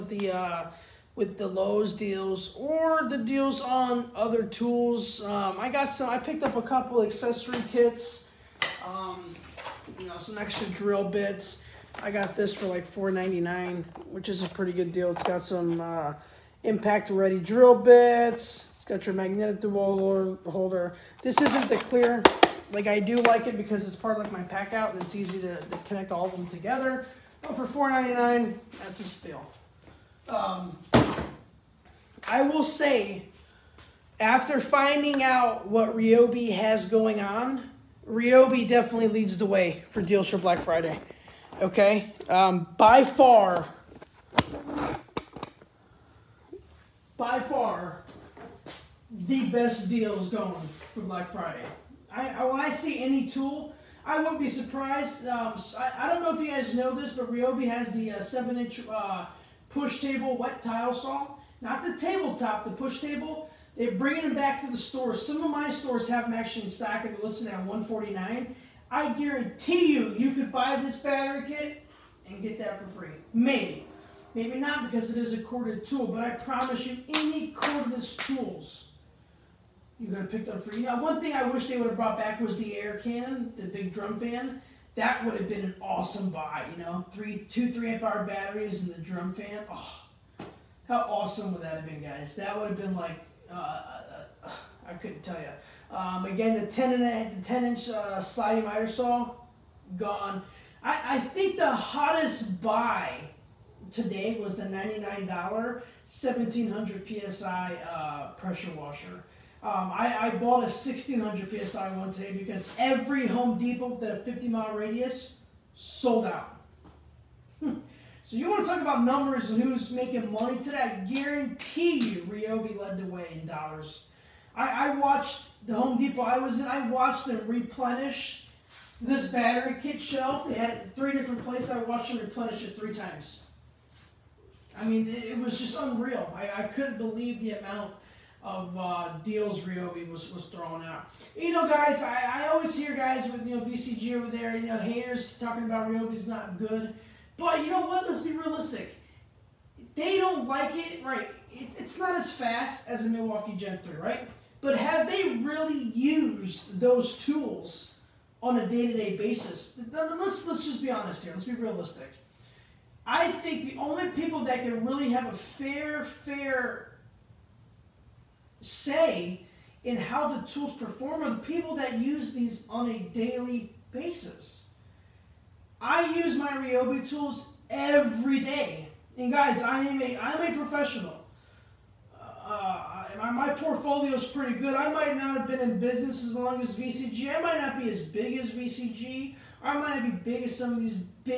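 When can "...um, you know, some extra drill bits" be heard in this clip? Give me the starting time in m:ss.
0:08.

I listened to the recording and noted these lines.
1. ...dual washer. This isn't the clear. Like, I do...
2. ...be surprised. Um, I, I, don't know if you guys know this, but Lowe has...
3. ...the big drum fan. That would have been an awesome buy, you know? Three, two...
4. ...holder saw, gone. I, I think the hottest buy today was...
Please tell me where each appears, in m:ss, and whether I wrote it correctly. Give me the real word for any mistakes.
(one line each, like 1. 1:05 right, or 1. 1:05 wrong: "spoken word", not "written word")
1. 0:19 wrong: "holder", not "washer"
2. 0:54 wrong: "Ryobi", not "Lowe"
3. 1:23 right
4. 1:38 wrong: "miter", not "holder".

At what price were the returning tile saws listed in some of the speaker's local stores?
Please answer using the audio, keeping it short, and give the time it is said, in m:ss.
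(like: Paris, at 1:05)
$149, at 1:07.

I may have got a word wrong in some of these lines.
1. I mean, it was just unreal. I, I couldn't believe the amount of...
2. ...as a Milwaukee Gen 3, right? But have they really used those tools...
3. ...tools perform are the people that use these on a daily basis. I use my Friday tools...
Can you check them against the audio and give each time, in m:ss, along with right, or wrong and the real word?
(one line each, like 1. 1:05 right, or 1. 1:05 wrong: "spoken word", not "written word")
1. 2:14 right
2. 2:32 right
3. 2:50 wrong: "Ryobi", not "Friday".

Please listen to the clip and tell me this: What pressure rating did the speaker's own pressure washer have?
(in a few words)
1600 psi.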